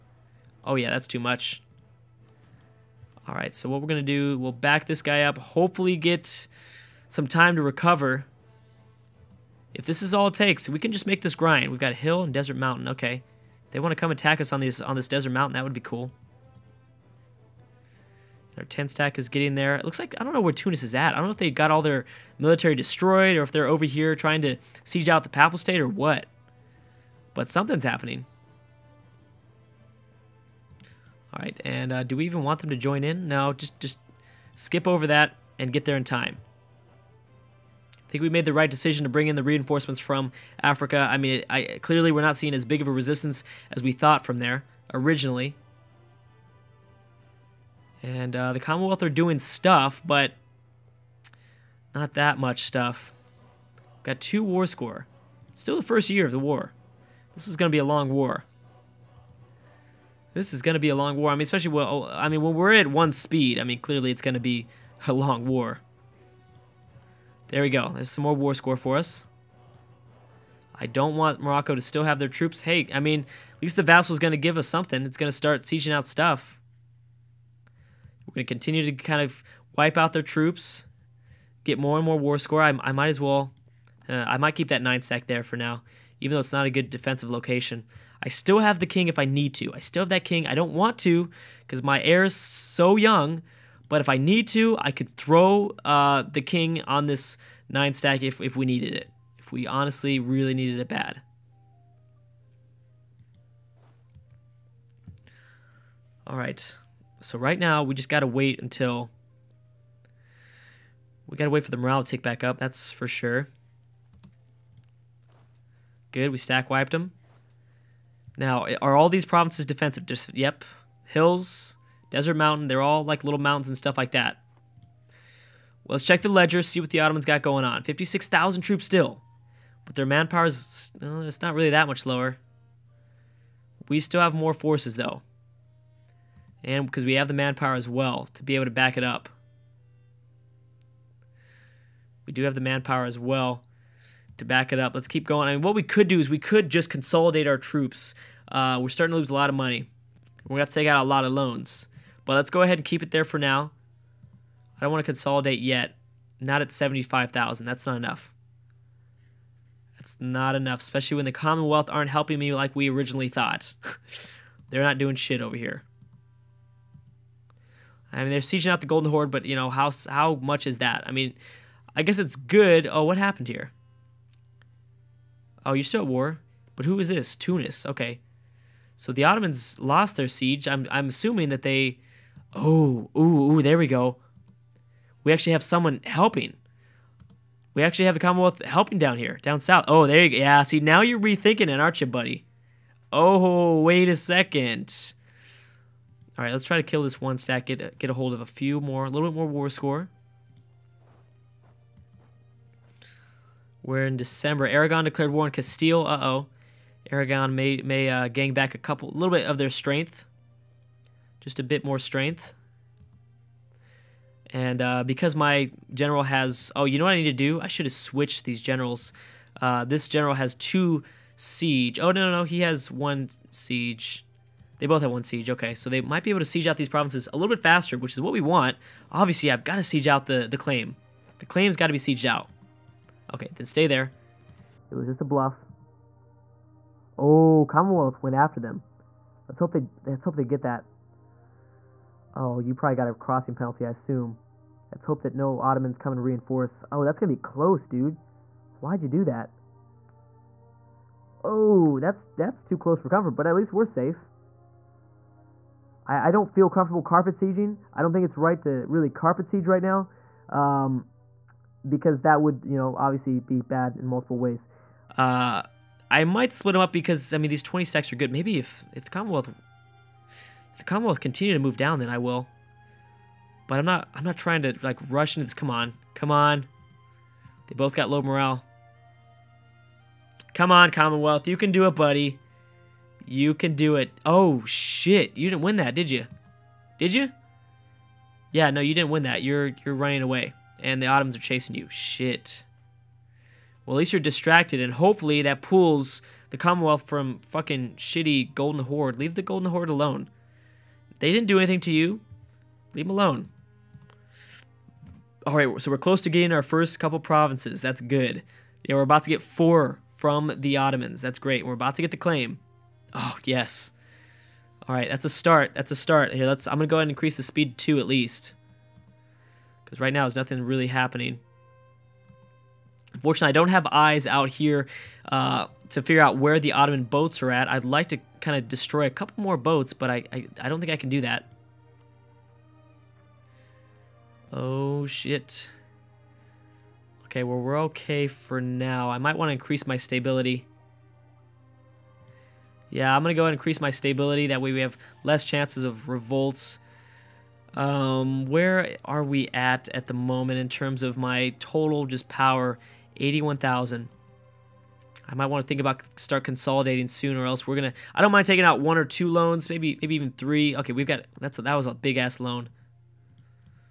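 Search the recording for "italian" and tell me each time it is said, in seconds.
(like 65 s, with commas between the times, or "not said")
not said.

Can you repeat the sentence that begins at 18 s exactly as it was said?
Our 10 stack is getting there.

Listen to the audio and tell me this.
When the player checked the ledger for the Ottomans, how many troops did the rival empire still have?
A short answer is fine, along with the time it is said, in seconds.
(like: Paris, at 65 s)
56,000, at 127 s.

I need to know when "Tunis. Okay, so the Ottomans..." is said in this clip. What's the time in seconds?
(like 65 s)
177 s.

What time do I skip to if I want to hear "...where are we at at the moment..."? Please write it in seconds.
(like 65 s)
348 s.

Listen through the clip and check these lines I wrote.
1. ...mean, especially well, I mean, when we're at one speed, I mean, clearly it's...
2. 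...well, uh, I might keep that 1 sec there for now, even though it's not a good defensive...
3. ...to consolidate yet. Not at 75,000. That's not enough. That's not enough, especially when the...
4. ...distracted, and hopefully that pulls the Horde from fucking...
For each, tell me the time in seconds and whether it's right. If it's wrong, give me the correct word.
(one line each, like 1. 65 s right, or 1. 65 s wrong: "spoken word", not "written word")
1. 61 s right
2. 83 s wrong: "9", not "1"
3. 155 s right
4. 294 s wrong: "Commonwealth", not "Horde".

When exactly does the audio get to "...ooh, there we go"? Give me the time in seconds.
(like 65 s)
183 s.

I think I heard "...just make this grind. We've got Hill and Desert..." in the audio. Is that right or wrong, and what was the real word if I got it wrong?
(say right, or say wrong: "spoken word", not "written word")
right.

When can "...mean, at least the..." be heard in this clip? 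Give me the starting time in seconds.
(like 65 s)
72 s.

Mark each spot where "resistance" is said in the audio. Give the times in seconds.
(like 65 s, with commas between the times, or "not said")
42 s.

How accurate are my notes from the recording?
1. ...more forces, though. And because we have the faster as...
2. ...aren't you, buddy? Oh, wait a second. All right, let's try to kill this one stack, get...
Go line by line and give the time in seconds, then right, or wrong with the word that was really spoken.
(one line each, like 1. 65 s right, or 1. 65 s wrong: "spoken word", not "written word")
1. 134 s wrong: "manpower", not "faster"
2. 191 s right.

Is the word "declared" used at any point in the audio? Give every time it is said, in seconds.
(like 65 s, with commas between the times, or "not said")
205 s.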